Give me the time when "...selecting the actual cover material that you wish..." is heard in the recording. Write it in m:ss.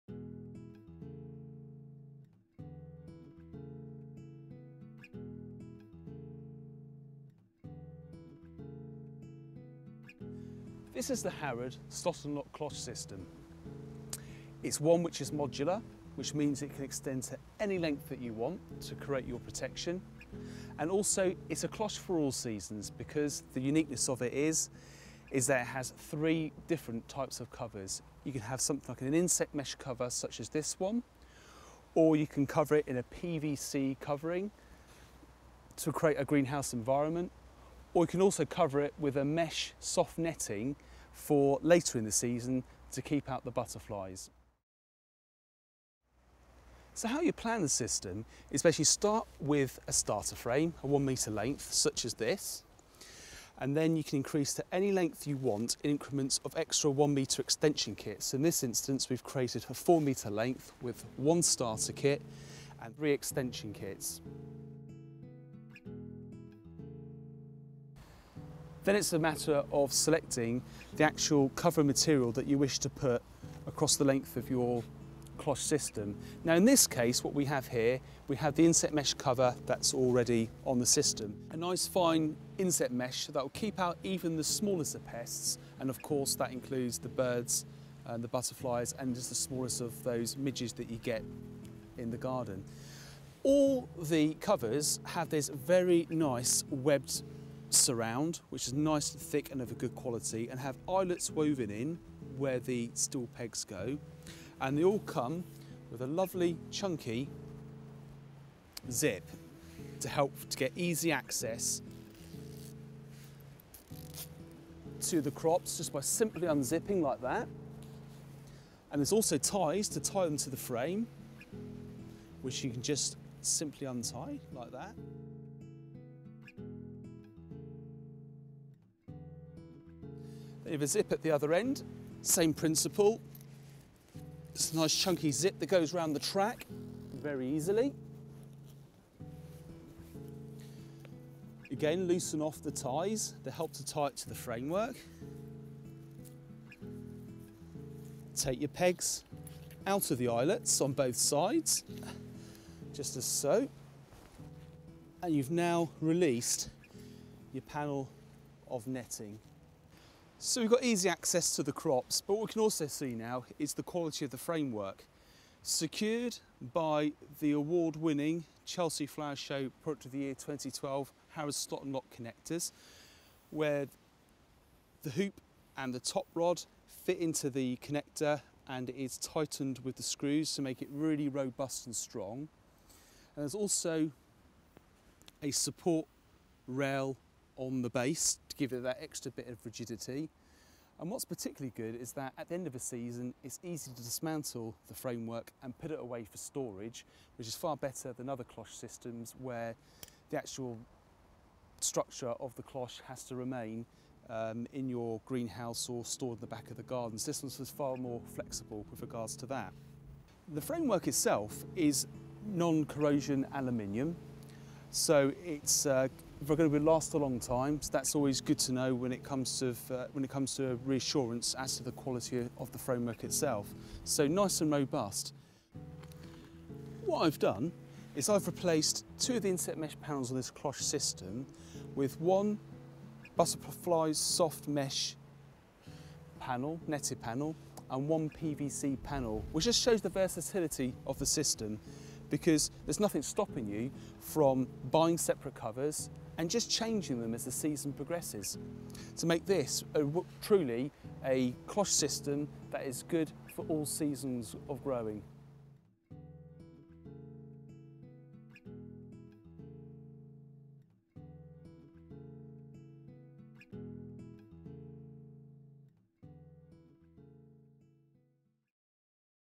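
1:09.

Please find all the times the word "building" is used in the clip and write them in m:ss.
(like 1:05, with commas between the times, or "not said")
not said.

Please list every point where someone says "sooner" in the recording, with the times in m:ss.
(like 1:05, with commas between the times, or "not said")
not said.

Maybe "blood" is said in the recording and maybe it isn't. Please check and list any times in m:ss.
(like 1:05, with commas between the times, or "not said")
not said.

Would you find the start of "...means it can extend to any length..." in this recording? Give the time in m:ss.
0:16.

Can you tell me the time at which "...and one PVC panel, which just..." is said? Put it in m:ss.
3:57.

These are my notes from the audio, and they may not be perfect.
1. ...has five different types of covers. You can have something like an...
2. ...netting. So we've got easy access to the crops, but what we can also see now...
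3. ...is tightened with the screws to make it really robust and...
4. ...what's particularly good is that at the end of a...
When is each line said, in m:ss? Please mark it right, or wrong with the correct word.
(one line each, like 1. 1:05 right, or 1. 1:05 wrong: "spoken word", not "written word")
1. 0:25 wrong: "three", not "five"
2. 2:38 right
3. 2:58 right
4. 3:11 right.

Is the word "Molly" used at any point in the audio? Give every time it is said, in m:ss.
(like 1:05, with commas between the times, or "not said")
not said.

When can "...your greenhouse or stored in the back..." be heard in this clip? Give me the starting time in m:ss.
3:24.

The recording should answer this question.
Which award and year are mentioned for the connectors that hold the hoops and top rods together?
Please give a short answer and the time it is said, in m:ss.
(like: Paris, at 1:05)
Chelsea Flower Show Product of the Year 2012, at 2:48.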